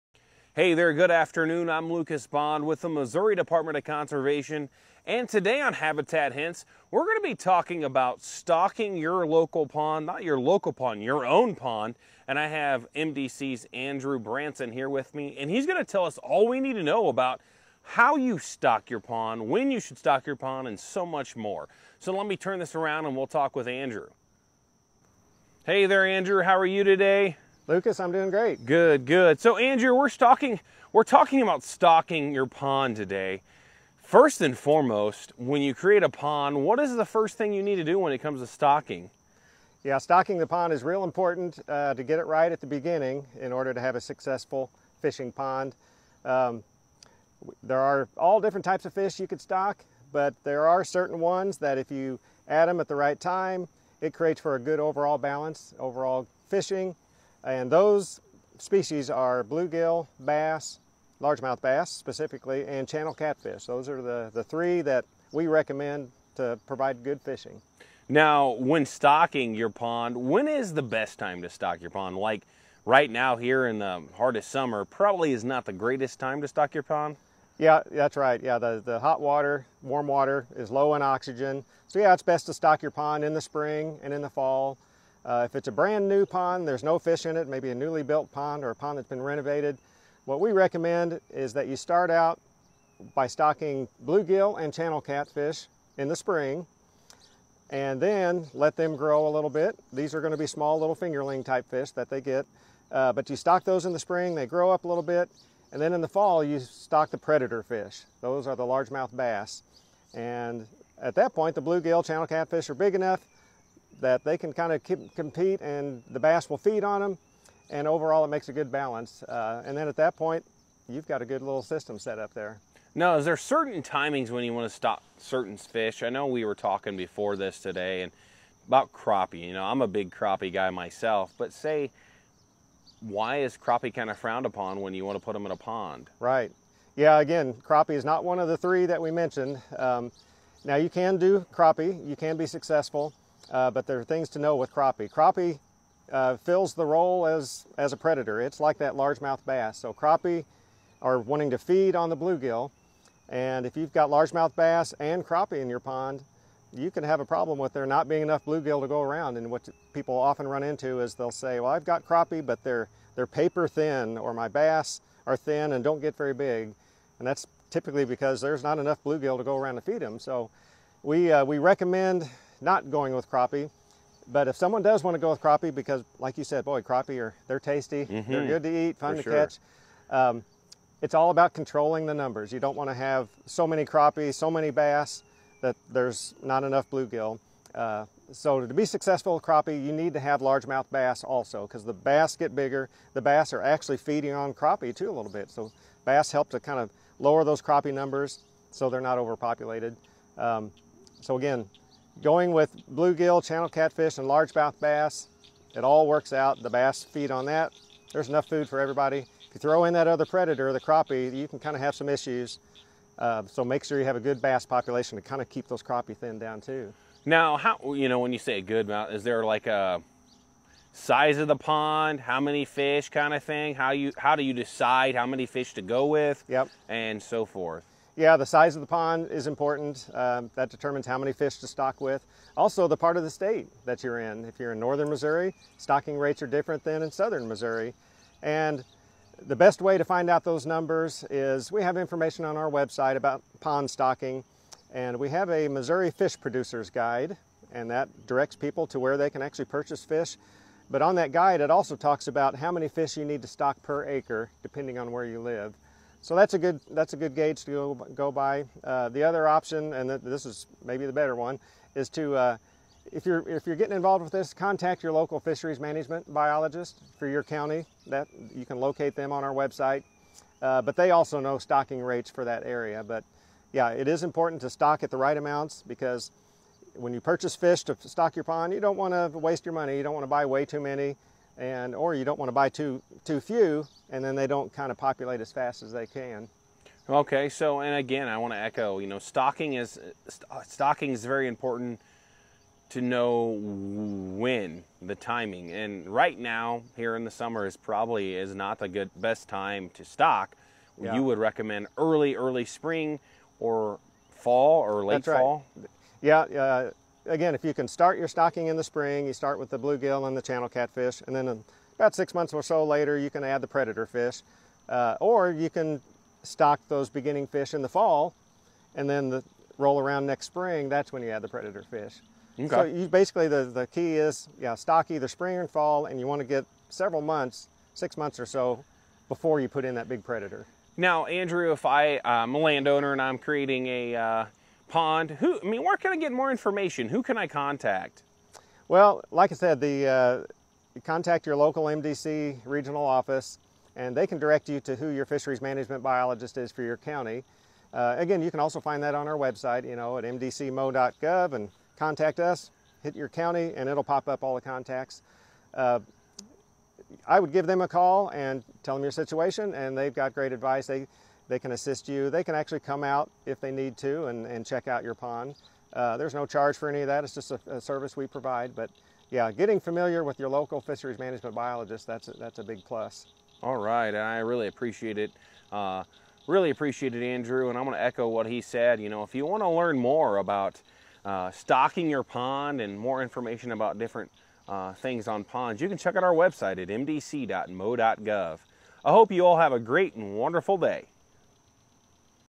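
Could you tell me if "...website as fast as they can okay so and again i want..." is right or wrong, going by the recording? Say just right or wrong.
wrong.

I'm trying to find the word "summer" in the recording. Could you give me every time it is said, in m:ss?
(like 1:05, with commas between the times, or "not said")
1:14, 4:57.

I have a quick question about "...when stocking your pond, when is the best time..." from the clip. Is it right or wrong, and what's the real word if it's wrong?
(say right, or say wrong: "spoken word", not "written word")
right.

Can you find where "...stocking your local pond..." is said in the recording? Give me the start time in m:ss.
0:08.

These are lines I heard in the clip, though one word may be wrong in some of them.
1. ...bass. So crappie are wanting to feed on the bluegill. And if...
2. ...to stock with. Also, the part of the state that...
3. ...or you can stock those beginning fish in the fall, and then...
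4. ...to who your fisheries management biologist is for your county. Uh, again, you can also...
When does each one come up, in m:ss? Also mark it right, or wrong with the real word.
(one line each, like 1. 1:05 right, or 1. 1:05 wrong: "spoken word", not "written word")
1. 2:29 right
2. 3:51 right
3. 5:15 right
4. 5:44 right.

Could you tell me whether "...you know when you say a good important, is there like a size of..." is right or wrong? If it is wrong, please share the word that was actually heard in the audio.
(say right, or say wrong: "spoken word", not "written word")
wrong: "amount", not "important".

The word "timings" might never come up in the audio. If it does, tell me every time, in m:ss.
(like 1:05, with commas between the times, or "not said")
2:03, 4:55.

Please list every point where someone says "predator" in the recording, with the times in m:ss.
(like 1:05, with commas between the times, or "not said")
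1:47, 2:27, 3:30, 5:13, 5:21, 5:30.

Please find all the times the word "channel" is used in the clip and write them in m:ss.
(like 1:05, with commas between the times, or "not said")
1:02, 1:34, 1:52, 3:23, 5:10.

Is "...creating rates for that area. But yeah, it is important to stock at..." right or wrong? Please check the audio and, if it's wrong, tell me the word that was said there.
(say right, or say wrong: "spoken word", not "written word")
wrong: "stocking", not "creating".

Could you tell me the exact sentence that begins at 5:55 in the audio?
Uh, I would give them a call and tell them your situation, and they've got great advice.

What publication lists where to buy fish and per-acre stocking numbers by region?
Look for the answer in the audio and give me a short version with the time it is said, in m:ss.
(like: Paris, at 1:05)
Missouri Fish Producers Guide, at 4:05.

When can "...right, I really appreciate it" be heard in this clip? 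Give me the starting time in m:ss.
6:13.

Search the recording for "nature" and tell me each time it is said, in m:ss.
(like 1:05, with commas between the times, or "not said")
not said.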